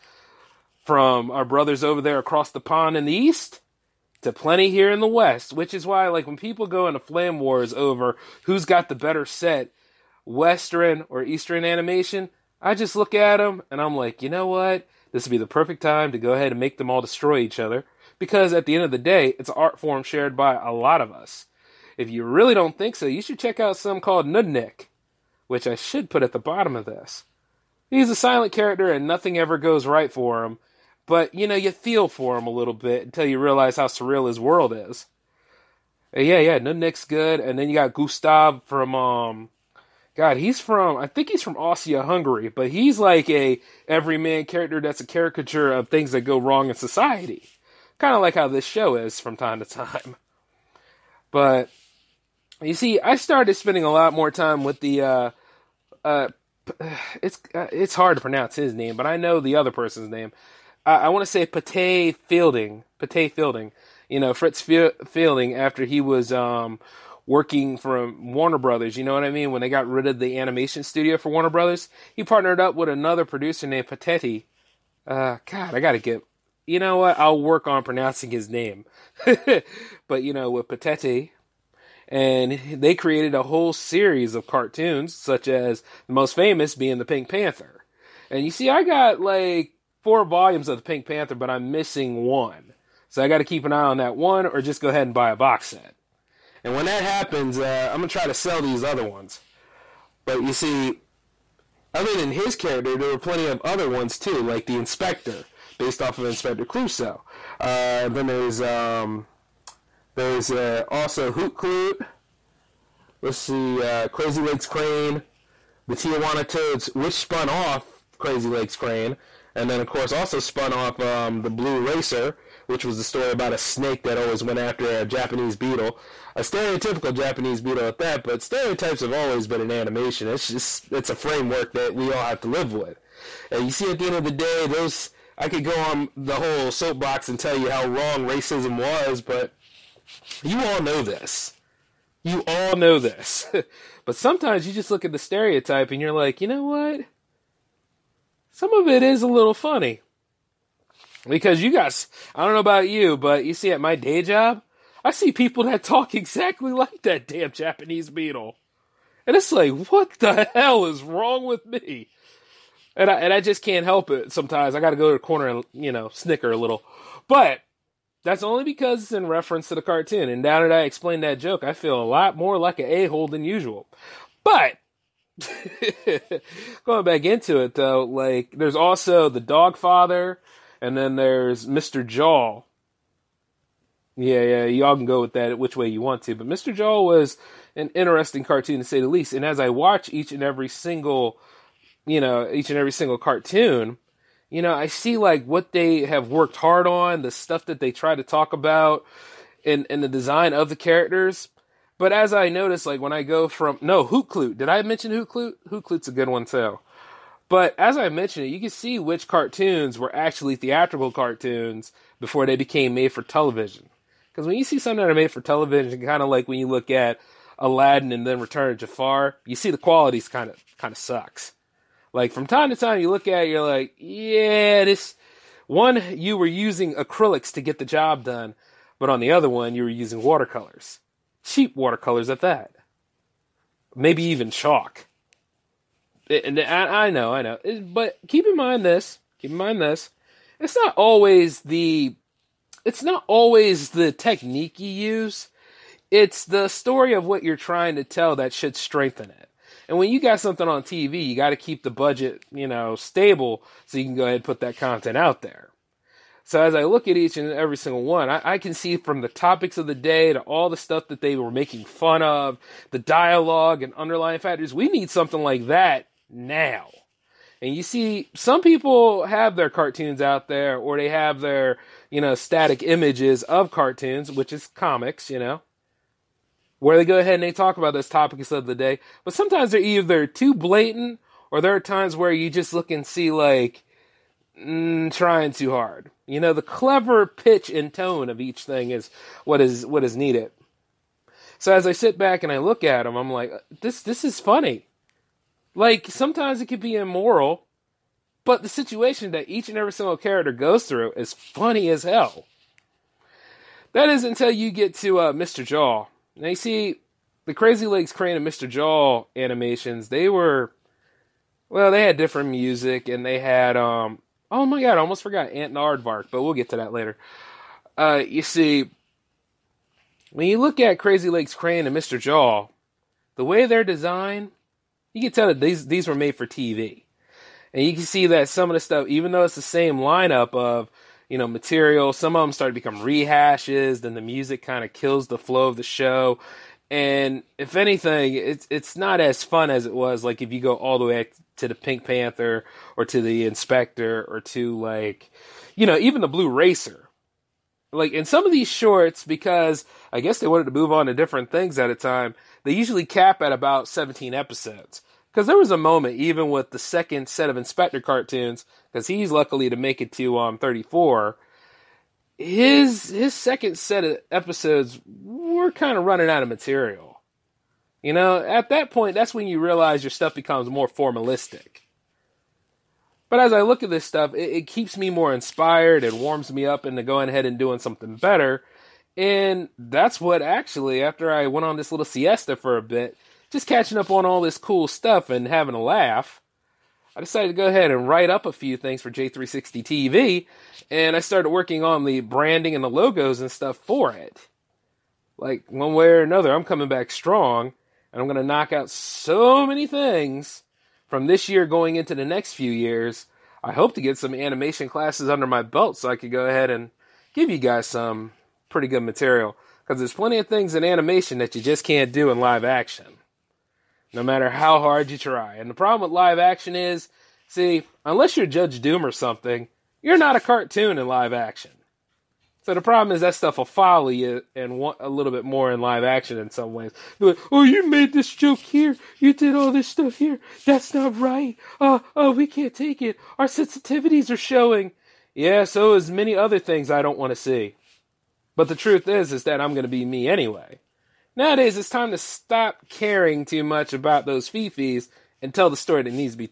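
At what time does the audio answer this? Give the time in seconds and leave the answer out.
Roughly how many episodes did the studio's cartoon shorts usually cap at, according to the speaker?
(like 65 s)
353 s.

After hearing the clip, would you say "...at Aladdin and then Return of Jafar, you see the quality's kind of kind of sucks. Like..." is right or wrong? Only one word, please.
right.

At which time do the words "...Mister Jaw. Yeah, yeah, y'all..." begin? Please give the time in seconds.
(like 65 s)
181 s.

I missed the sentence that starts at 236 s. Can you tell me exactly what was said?
And I, I know, I know, but keep in mind this.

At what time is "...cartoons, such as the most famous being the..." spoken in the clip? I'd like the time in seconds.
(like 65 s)
84 s.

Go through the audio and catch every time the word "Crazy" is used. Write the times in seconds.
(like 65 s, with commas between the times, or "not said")
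114 s, 118 s, 307 s, 320 s.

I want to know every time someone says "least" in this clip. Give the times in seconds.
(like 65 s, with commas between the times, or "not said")
189 s.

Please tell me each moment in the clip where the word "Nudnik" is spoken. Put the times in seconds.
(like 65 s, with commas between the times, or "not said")
24 s, 36 s.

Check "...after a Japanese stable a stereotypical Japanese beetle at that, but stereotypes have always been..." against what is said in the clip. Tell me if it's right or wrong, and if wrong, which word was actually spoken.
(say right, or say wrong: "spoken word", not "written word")
wrong: "beetle", not "stable".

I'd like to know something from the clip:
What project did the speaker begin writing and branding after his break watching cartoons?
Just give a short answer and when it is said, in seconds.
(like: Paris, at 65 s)
J360 TV, at 389 s.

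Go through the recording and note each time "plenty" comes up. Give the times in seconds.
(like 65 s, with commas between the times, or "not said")
4 s, 103 s, 410 s.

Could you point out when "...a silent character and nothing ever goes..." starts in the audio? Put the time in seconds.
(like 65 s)
28 s.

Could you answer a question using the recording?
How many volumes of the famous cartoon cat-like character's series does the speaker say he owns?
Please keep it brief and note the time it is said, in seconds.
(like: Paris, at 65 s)
4, at 90 s.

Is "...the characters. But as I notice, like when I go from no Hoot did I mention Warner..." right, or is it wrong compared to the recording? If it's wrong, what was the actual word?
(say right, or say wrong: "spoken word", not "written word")
wrong: "Hoot", not "Warner".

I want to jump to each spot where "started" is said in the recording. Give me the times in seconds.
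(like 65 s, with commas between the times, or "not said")
53 s, 332 s, 391 s.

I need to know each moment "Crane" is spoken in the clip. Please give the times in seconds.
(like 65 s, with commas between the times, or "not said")
114 s, 118 s, 308 s, 321 s.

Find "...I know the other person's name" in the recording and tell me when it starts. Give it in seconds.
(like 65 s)
59 s.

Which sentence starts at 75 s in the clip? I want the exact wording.
Uh, God, I gotta get you know what?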